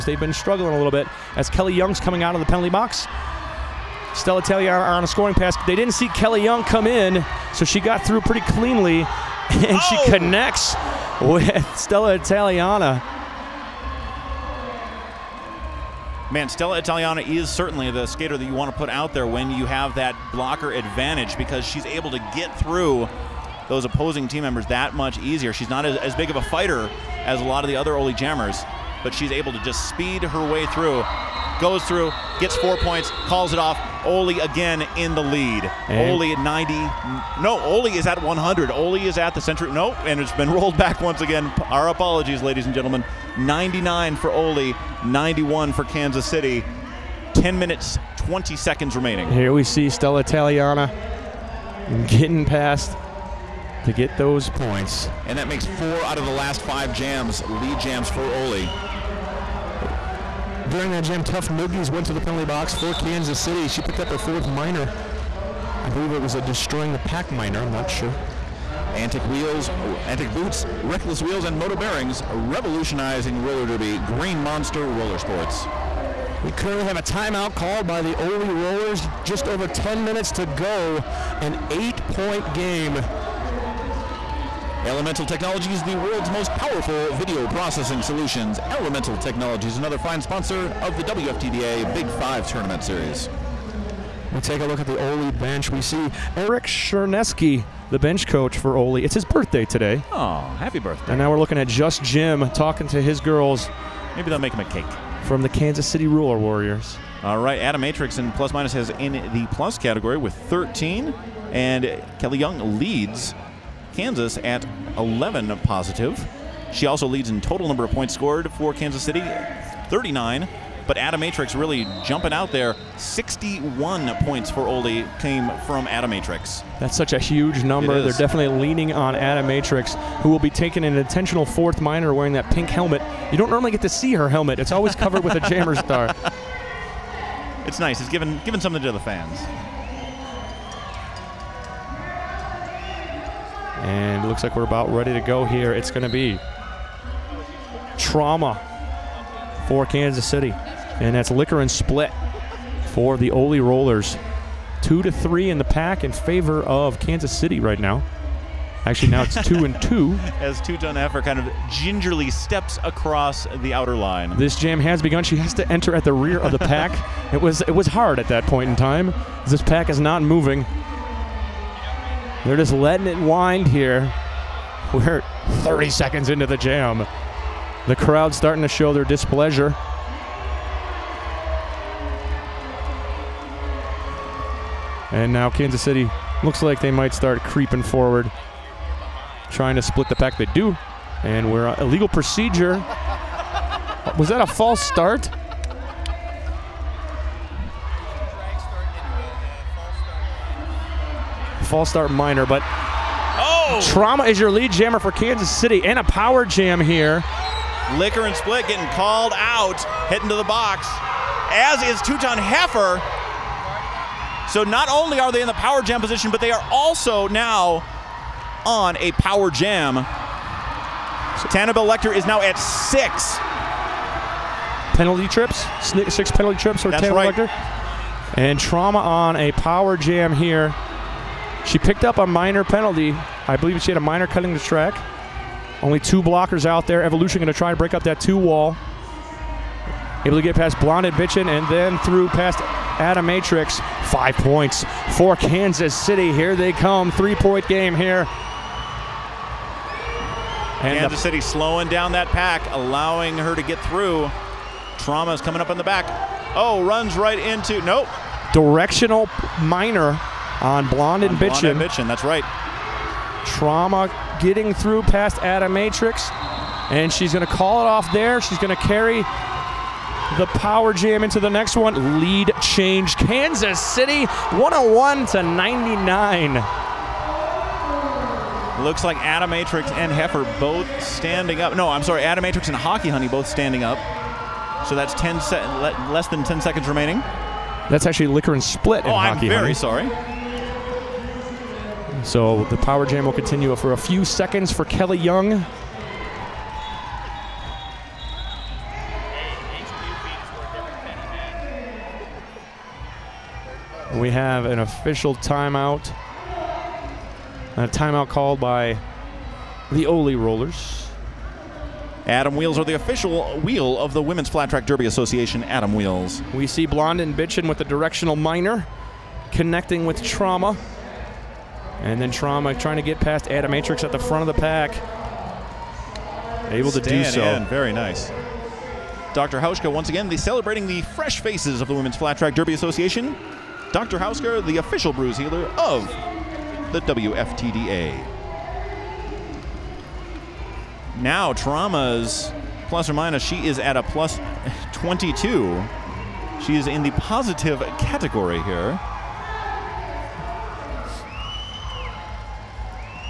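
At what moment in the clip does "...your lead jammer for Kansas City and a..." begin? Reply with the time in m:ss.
3:24.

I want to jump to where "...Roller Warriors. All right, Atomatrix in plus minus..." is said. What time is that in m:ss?
1:46.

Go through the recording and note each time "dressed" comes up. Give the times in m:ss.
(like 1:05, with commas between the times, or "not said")
not said.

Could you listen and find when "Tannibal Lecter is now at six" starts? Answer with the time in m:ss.
3:41.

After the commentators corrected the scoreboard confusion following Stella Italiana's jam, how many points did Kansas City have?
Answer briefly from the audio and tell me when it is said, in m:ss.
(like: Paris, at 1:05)
91, at 0:45.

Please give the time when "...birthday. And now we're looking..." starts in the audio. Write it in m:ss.
1:40.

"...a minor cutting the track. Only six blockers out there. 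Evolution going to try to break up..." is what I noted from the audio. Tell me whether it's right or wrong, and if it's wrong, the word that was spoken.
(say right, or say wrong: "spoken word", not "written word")
wrong: "two", not "six".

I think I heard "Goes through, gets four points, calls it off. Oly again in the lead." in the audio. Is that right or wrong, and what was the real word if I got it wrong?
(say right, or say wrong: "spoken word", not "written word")
right.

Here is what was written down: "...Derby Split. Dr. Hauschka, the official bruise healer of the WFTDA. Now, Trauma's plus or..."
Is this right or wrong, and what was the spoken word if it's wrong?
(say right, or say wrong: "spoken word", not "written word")
wrong: "Association", not "Split".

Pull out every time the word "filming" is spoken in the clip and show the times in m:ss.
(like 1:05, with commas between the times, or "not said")
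not said.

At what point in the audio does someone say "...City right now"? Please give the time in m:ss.
2:37.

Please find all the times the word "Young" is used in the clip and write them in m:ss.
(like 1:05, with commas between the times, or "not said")
0:01, 0:06, 1:52, 4:55.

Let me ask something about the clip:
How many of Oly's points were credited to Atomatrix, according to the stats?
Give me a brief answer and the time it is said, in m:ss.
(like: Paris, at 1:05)
61, at 2:02.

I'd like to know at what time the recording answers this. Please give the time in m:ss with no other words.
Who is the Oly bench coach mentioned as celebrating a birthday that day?
1:36.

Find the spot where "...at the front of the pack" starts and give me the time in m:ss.
5:24.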